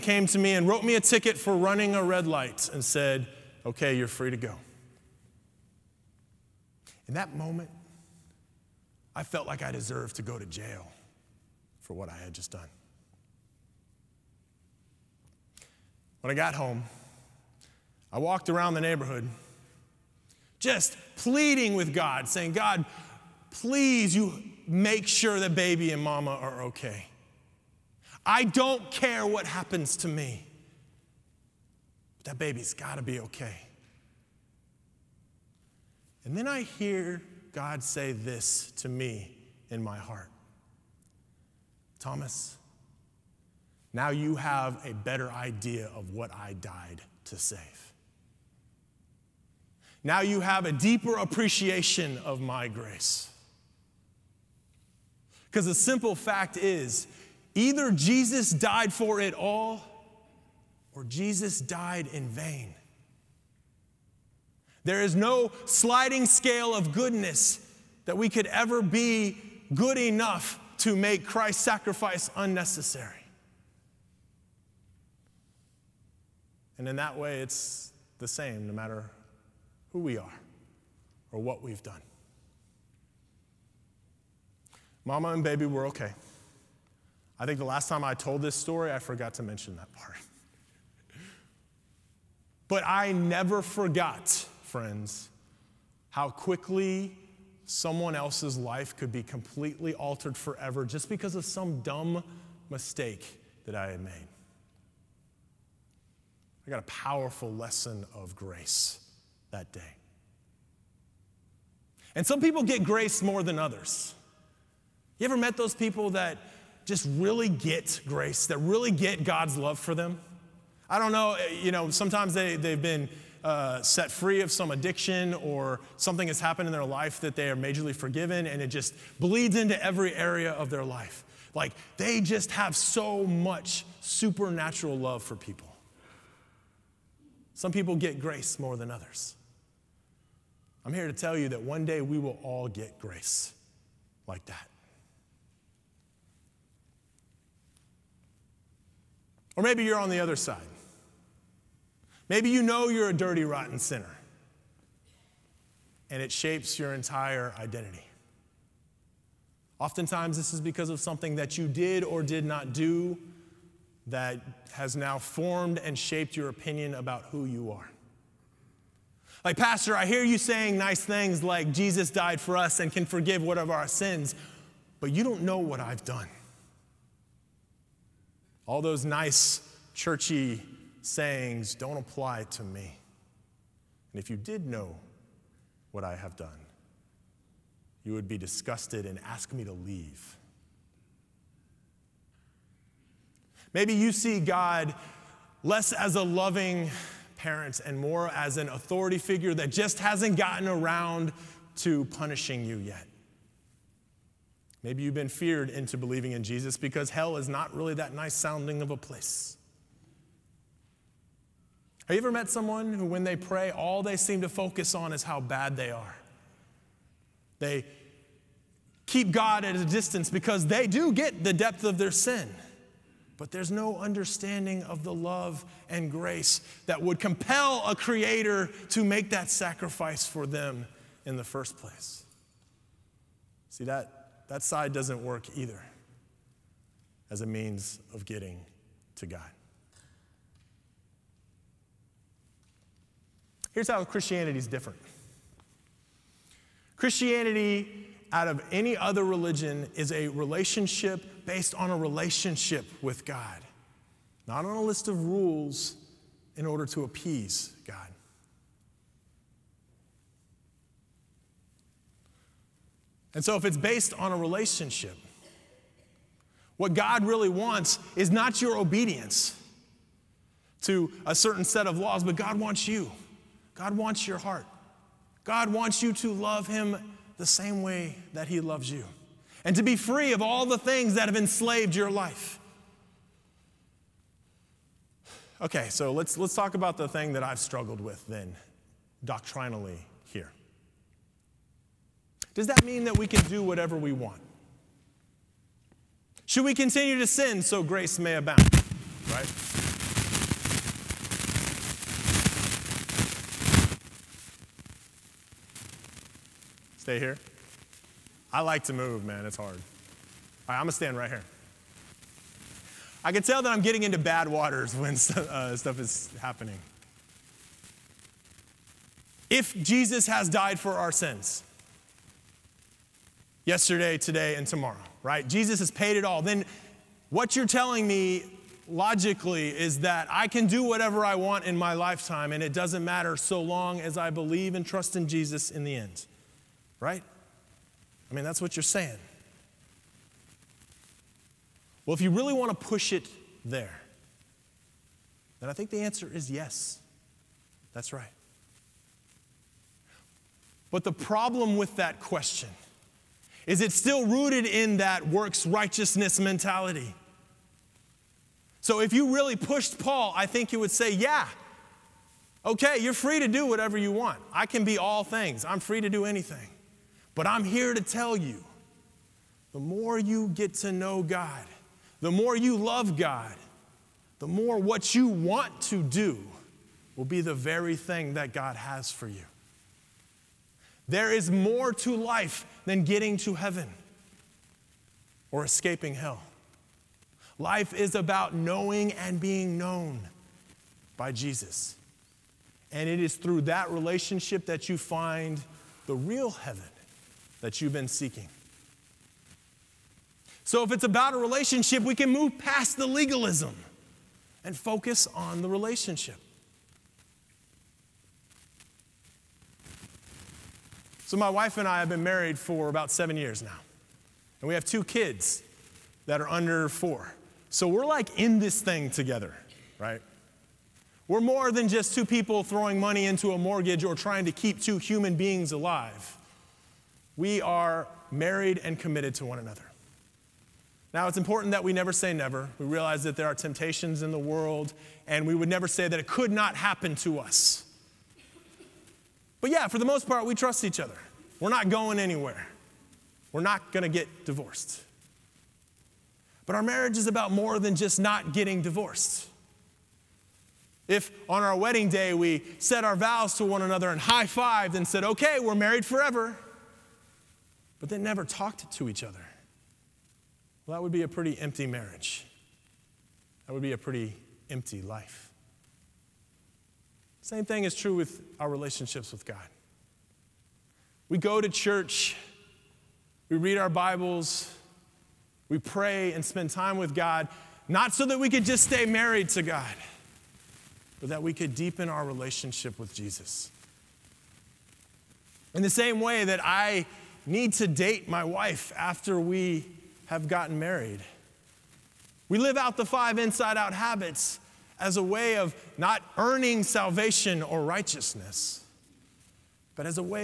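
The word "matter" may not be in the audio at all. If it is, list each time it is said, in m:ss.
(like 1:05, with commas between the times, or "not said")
1:18, 5:33.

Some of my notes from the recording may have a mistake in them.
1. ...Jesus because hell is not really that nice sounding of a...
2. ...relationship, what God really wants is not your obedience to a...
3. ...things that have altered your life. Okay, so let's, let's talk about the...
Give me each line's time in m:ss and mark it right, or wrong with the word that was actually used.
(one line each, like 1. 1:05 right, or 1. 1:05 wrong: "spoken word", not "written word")
1. 3:26 right
2. 4:24 right
3. 4:40 wrong: "enslaved", not "altered".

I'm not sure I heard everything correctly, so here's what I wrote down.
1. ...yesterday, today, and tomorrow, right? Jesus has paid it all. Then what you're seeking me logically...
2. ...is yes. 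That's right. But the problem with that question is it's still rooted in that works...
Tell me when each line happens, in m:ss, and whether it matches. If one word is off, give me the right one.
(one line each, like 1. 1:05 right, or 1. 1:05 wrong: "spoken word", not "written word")
1. 5:23 wrong: "telling", not "seeking"
2. 5:46 right.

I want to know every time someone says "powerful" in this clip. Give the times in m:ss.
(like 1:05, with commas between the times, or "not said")
1:46.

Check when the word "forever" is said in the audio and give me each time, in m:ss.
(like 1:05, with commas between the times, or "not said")
1:40, 7:36.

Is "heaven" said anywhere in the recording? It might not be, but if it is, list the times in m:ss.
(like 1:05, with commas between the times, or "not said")
6:23, 6:36.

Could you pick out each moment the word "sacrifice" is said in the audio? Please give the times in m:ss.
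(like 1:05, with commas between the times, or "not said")
1:11, 3:49.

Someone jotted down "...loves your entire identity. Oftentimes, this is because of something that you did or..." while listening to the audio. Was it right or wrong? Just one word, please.
wrong.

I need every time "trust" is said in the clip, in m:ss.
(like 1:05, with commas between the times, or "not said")
5:34, 7:20.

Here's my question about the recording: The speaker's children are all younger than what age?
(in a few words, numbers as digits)
4.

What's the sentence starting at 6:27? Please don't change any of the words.
Life is about knowing and being known by Jesus.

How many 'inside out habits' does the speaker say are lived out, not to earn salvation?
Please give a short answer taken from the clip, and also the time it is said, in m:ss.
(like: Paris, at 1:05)
5, at 8:13.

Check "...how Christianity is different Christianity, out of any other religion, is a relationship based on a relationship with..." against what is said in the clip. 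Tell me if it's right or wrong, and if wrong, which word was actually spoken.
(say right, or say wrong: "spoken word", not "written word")
right.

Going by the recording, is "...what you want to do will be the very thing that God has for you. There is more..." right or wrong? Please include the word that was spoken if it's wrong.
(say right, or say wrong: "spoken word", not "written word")
right.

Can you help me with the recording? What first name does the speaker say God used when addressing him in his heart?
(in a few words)
Thomas.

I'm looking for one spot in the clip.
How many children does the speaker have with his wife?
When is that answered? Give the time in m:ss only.
6:54.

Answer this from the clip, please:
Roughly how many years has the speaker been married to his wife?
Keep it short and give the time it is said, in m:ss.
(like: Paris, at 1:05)
7, at 6:53.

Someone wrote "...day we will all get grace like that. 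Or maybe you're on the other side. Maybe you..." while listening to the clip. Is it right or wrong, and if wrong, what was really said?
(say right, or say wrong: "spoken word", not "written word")
right.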